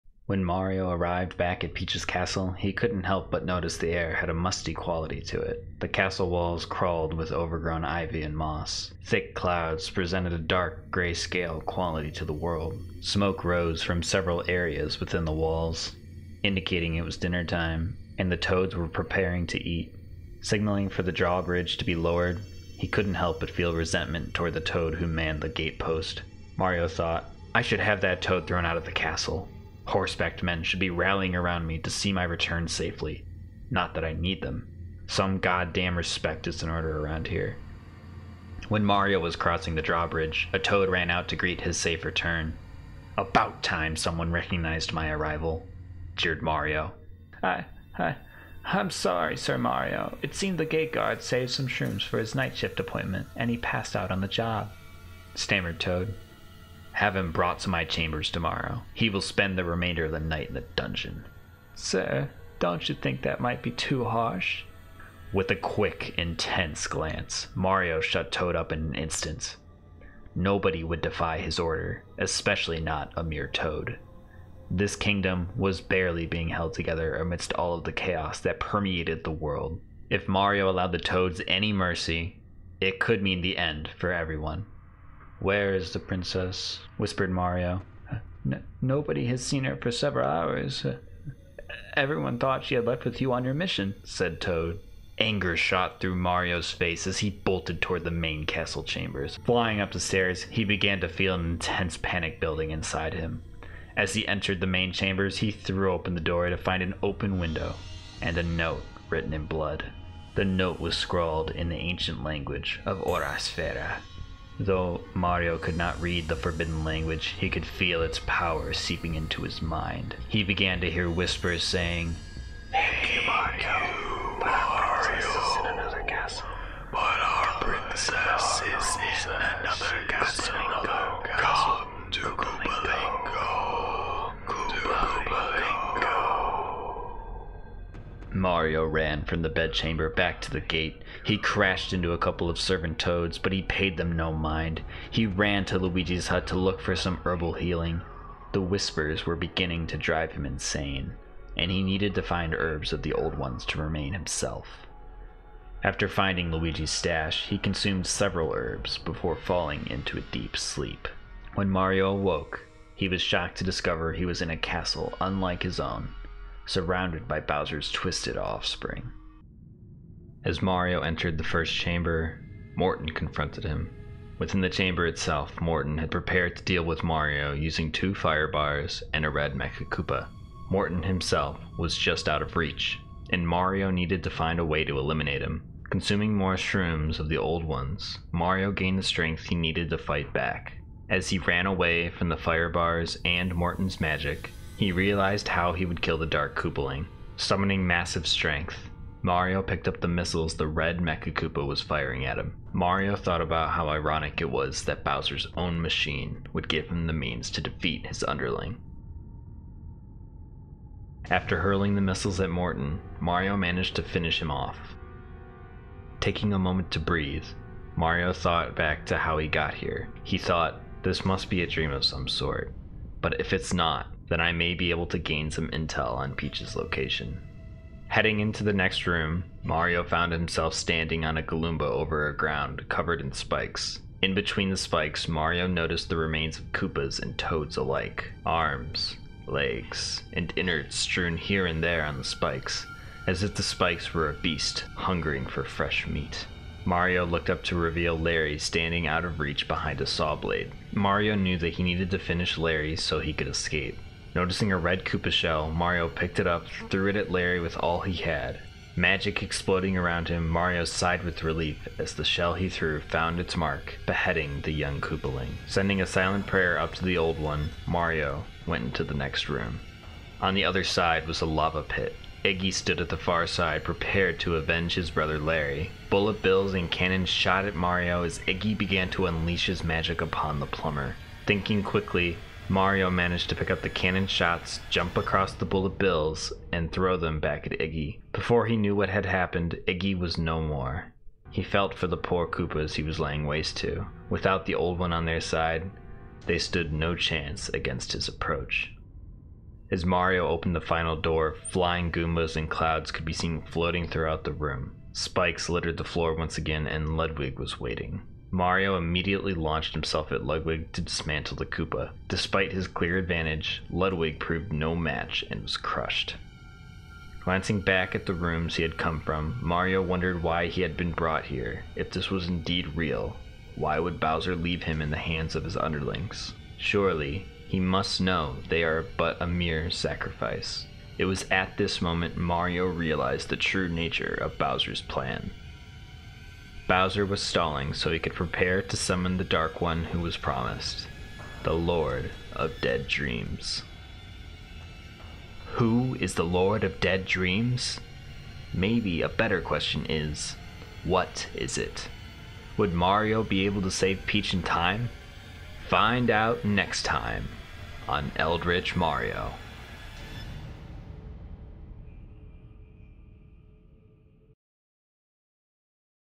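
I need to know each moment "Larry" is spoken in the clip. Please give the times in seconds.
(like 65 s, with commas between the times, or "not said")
248 s, 252 s, 257 s, 275 s.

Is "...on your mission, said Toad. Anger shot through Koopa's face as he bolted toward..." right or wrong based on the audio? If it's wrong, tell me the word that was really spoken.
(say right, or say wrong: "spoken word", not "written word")
wrong: "Mario", not "Koopa".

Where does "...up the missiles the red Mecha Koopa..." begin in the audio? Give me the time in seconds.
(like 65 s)
199 s.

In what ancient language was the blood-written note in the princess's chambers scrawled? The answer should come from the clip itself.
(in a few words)
Orasfera.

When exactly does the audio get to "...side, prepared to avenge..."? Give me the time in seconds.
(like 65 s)
273 s.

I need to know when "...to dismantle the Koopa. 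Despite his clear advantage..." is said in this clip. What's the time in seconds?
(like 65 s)
310 s.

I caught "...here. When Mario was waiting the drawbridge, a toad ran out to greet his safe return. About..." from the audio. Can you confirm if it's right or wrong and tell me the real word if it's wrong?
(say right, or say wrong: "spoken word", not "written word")
wrong: "crossing", not "waiting".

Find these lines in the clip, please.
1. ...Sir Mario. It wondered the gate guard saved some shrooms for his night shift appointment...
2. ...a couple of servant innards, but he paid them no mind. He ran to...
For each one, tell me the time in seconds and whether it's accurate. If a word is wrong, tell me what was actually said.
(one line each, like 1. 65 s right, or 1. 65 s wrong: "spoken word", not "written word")
1. 49 s wrong: "seemed", not "wondered"
2. 142 s wrong: "toads", not "innards".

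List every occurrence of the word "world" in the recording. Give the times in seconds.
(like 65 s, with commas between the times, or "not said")
12 s, 79 s.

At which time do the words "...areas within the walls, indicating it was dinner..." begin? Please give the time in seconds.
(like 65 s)
14 s.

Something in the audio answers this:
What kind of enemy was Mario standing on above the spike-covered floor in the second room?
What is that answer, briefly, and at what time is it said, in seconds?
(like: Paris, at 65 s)
Galoomba, at 231 s.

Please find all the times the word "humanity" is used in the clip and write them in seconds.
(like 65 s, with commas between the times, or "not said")
not said.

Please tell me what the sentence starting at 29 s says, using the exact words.
Horsebacked men should be rallying around me to see my return safely.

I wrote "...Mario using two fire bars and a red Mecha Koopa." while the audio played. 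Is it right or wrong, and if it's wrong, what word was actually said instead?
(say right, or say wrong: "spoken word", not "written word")
right.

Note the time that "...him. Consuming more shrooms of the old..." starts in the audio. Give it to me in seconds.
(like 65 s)
185 s.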